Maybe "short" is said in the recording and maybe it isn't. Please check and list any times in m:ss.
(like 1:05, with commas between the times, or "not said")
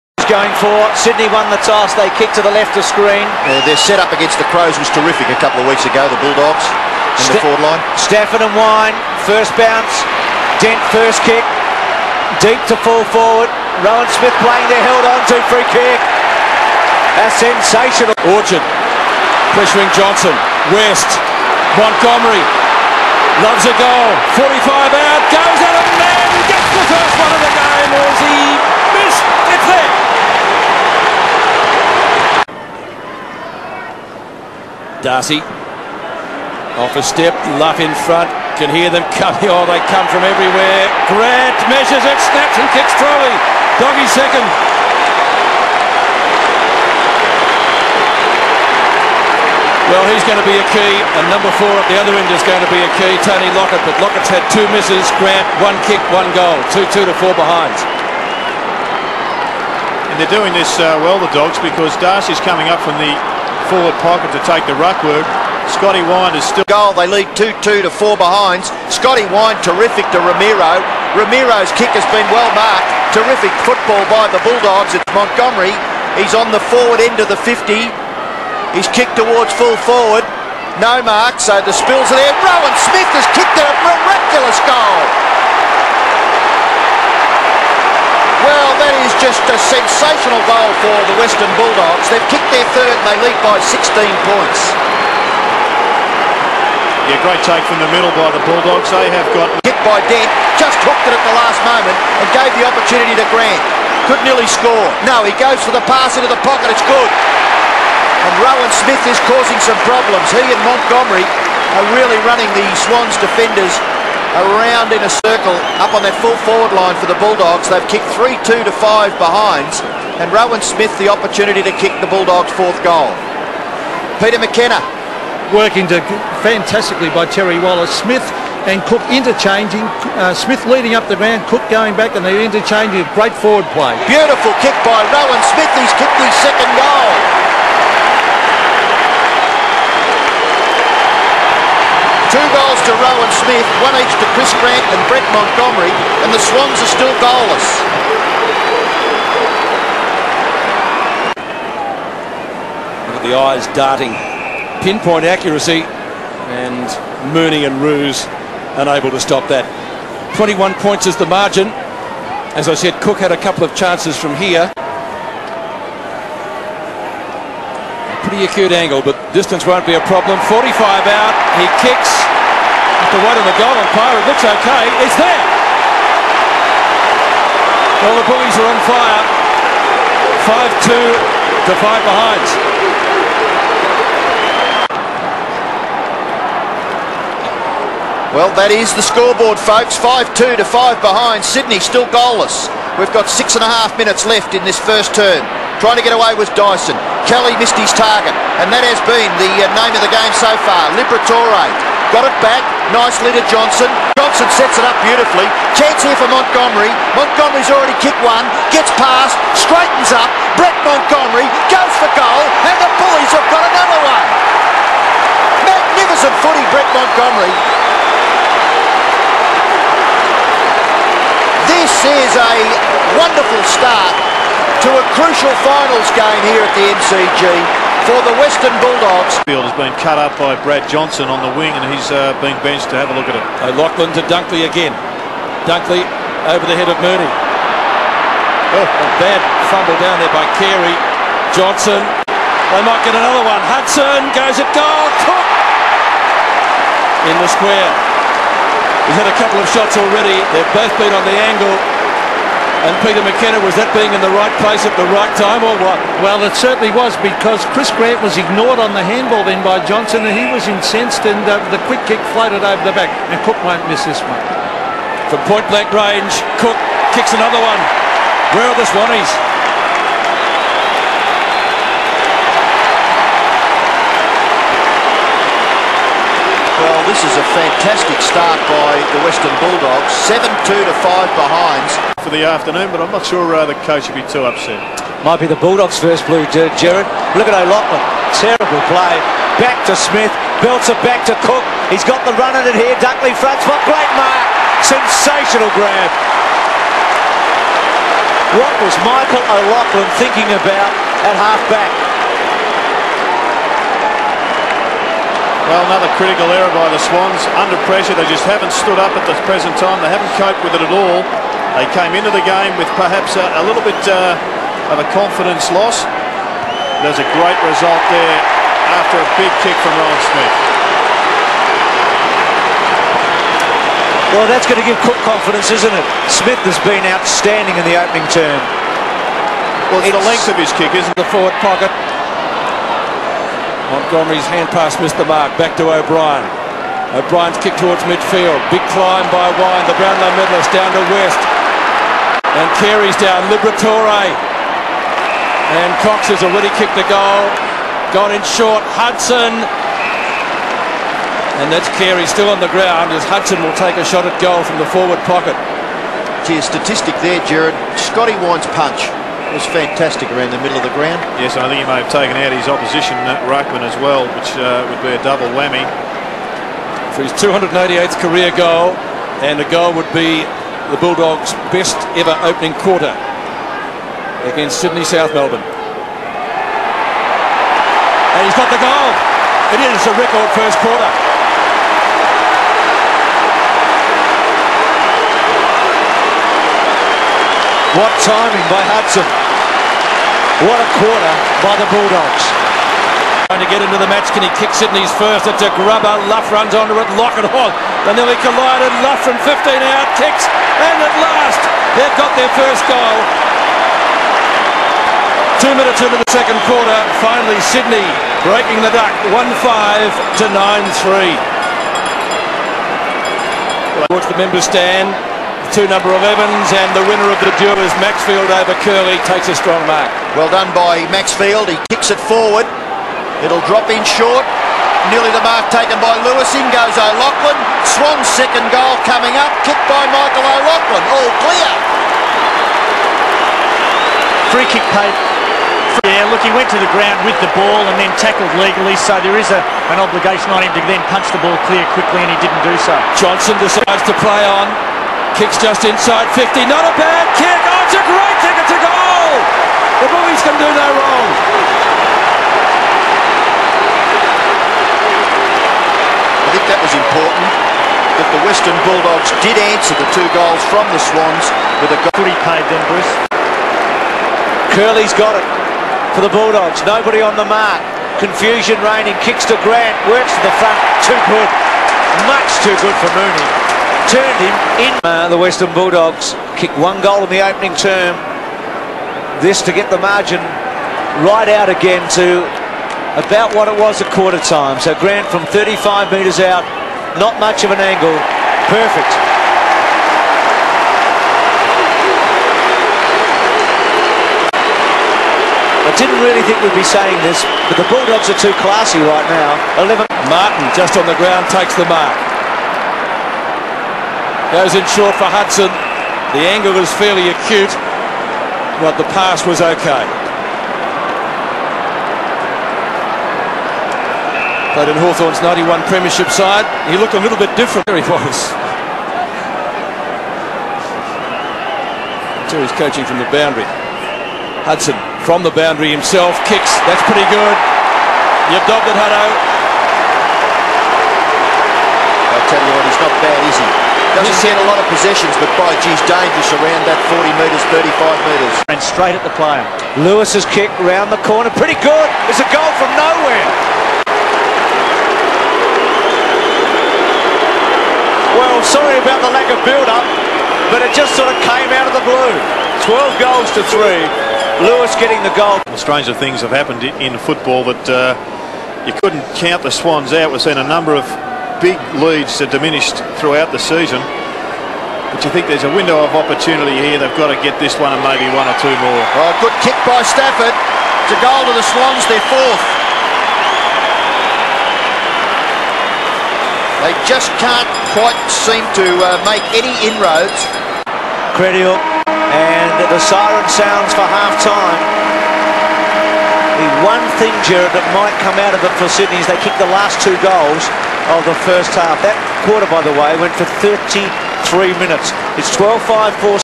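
5:48, 7:04, 8:24.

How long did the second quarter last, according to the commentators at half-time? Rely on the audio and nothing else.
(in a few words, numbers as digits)
33 minutes.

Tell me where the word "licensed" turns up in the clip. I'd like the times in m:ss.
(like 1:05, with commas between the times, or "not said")
not said.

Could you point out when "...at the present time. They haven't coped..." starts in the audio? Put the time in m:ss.
5:09.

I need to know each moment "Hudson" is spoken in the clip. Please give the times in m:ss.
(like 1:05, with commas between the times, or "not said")
4:03, 5:48, 5:53, 6:28, 8:25, 8:44.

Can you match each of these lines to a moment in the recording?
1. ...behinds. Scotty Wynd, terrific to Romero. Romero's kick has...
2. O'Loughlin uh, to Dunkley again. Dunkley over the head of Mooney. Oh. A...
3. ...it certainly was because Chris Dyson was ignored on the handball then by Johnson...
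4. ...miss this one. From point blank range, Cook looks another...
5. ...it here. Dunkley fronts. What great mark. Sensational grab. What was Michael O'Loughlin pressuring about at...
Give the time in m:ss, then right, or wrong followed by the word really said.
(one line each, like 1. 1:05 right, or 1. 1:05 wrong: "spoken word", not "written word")
1. 1:08 right
2. 3:53 right
3. 4:16 wrong: "Grant", not "Dyson"
4. 4:23 wrong: "kicks", not "looks"
5. 4:52 wrong: "thinking", not "pressuring".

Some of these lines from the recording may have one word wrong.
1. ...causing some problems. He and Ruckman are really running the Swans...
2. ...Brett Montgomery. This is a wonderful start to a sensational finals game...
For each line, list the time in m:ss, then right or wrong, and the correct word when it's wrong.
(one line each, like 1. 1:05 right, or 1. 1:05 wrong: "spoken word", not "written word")
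1. 1:49 wrong: "Montgomery", not "Ruckman"
2. 3:36 wrong: "crucial", not "sensational".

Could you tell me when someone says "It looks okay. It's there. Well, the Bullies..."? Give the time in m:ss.
2:54.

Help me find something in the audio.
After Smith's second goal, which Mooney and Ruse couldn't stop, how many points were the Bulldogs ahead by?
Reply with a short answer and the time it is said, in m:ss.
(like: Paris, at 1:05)
21, at 2:40.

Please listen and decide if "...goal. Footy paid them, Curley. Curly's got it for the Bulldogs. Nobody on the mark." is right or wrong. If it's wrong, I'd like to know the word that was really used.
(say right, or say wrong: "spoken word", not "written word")
wrong: "Bruce", not "Curley".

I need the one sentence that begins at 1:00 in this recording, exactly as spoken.
And they're doing this uh, well, the Dogs, because Darcy's coming up from the forward pocket to take the ruck work.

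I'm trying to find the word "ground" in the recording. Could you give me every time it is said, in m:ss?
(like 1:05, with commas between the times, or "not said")
5:52, 6:00, 7:16, 8:21.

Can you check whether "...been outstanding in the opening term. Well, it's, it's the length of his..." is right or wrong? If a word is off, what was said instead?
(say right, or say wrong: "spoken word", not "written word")
right.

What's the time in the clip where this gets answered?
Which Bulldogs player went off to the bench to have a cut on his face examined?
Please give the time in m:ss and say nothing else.
3:50.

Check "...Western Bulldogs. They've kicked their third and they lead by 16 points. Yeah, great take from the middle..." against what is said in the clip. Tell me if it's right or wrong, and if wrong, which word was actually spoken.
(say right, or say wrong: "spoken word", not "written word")
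right.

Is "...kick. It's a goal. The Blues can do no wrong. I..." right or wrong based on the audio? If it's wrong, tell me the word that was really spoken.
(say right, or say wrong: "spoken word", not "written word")
right.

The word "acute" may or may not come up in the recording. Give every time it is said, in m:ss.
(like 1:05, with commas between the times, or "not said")
2:48, 8:27.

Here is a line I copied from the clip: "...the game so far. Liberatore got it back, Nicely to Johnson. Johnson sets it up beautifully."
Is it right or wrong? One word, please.
right.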